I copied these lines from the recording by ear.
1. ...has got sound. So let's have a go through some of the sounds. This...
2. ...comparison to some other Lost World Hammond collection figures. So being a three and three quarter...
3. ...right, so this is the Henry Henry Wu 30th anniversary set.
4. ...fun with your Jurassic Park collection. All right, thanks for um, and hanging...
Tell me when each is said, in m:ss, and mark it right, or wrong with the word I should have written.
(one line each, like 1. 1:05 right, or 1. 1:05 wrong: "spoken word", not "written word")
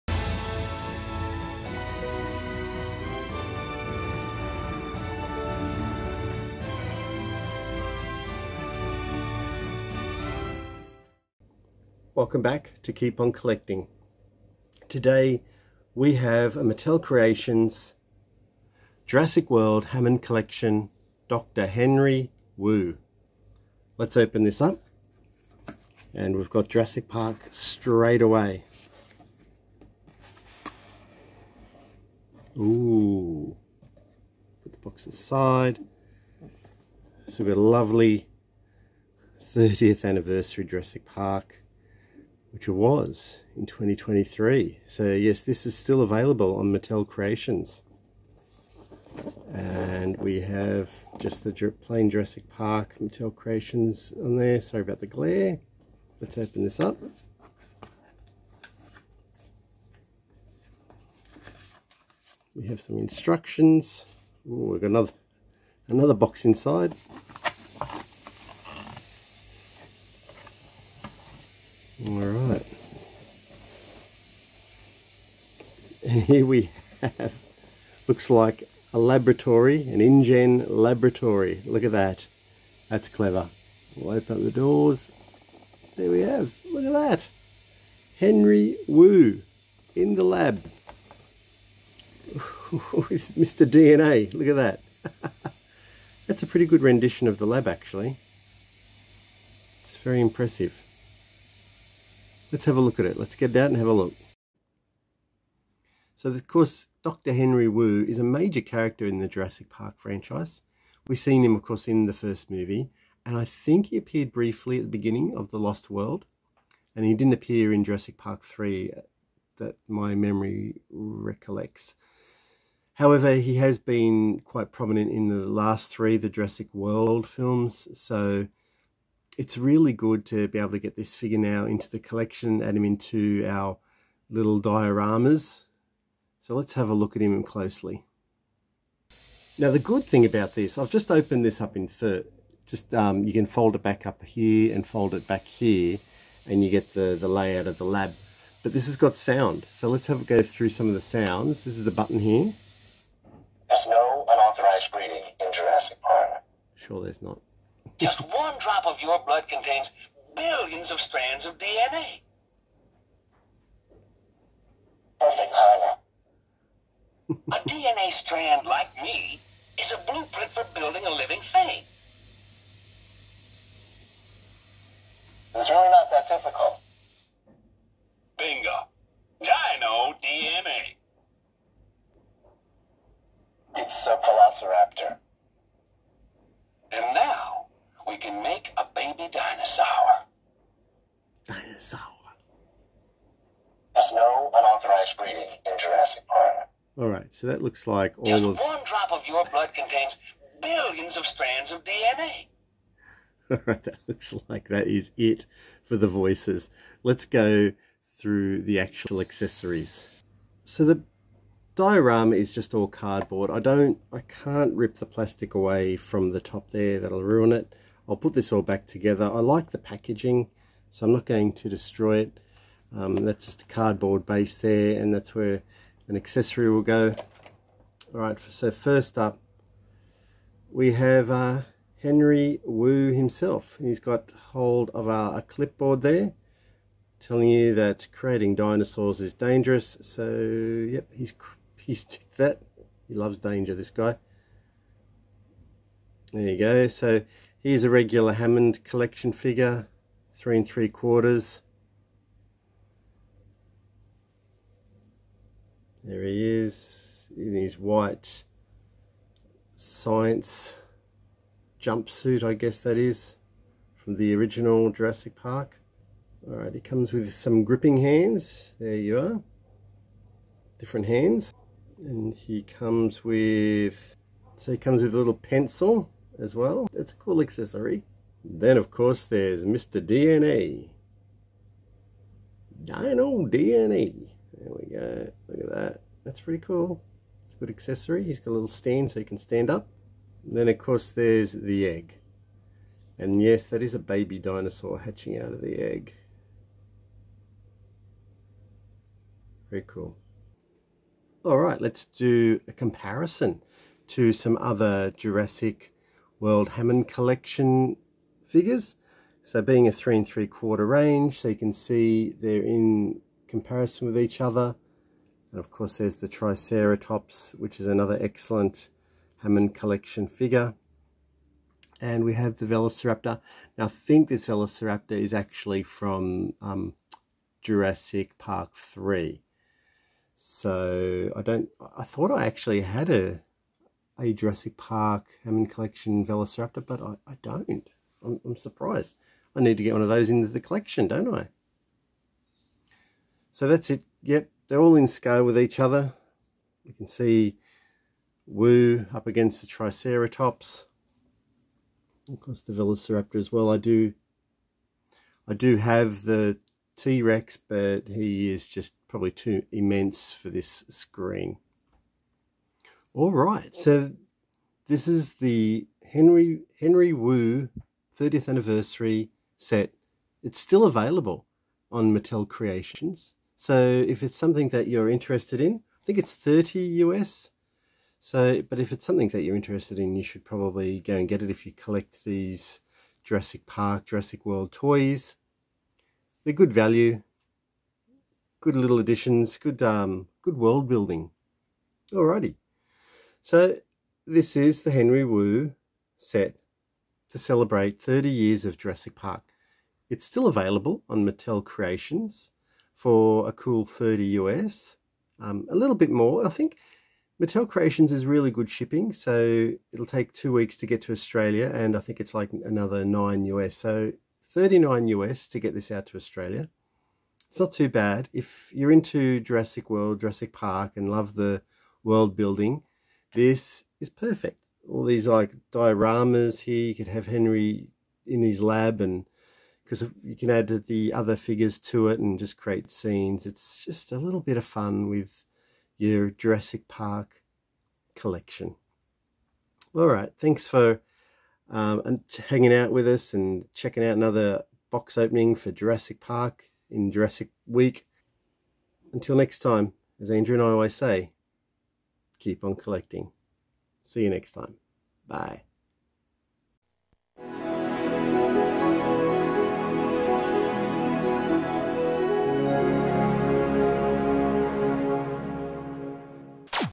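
1. 2:28 right
2. 5:02 wrong: "Jurassic", not "Lost"
3. 6:03 right
4. 7:14 right.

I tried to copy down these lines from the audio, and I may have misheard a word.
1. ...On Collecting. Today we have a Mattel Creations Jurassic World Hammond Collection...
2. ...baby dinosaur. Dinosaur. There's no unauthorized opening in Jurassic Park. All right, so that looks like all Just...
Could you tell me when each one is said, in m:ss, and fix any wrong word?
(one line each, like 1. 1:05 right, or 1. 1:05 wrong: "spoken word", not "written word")
1. 0:13 right
2. 3:08 wrong: "breeding", not "opening".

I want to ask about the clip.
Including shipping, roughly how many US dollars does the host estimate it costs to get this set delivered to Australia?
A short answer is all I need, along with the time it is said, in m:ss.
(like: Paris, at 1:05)
39, at 6:54.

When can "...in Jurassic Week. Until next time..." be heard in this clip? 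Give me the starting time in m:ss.
7:26.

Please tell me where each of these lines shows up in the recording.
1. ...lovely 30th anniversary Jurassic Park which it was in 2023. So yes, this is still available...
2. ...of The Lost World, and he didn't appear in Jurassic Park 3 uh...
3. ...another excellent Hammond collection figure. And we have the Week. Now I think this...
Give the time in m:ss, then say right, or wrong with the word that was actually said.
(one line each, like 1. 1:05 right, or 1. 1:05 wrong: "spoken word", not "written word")
1. 0:37 right
2. 1:55 right
3. 5:17 wrong: "Velociraptor", not "Week".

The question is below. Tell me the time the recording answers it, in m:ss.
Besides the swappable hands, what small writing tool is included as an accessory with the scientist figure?
4:35.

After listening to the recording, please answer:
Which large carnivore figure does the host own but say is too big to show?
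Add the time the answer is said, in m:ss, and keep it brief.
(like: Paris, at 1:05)
T-Rex, at 5:56.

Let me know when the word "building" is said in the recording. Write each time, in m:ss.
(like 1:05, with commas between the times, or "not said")
2:50, 6:30, 7:02.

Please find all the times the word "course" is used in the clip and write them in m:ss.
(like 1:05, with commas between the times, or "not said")
1:46, 1:51, 4:38, 4:50, 5:15, 5:52.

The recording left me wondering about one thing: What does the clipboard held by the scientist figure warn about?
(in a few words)
creating dinosaurs is dangerous.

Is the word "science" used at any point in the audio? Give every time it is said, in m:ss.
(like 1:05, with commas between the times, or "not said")
4:19.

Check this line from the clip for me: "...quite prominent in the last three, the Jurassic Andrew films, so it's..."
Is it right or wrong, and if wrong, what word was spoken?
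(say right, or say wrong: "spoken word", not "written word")
wrong: "World", not "Andrew".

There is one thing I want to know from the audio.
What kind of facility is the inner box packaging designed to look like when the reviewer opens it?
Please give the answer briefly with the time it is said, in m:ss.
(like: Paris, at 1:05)
InGen laboratory, at 1:20.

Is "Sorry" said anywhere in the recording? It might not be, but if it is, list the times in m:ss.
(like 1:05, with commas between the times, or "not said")
0:54.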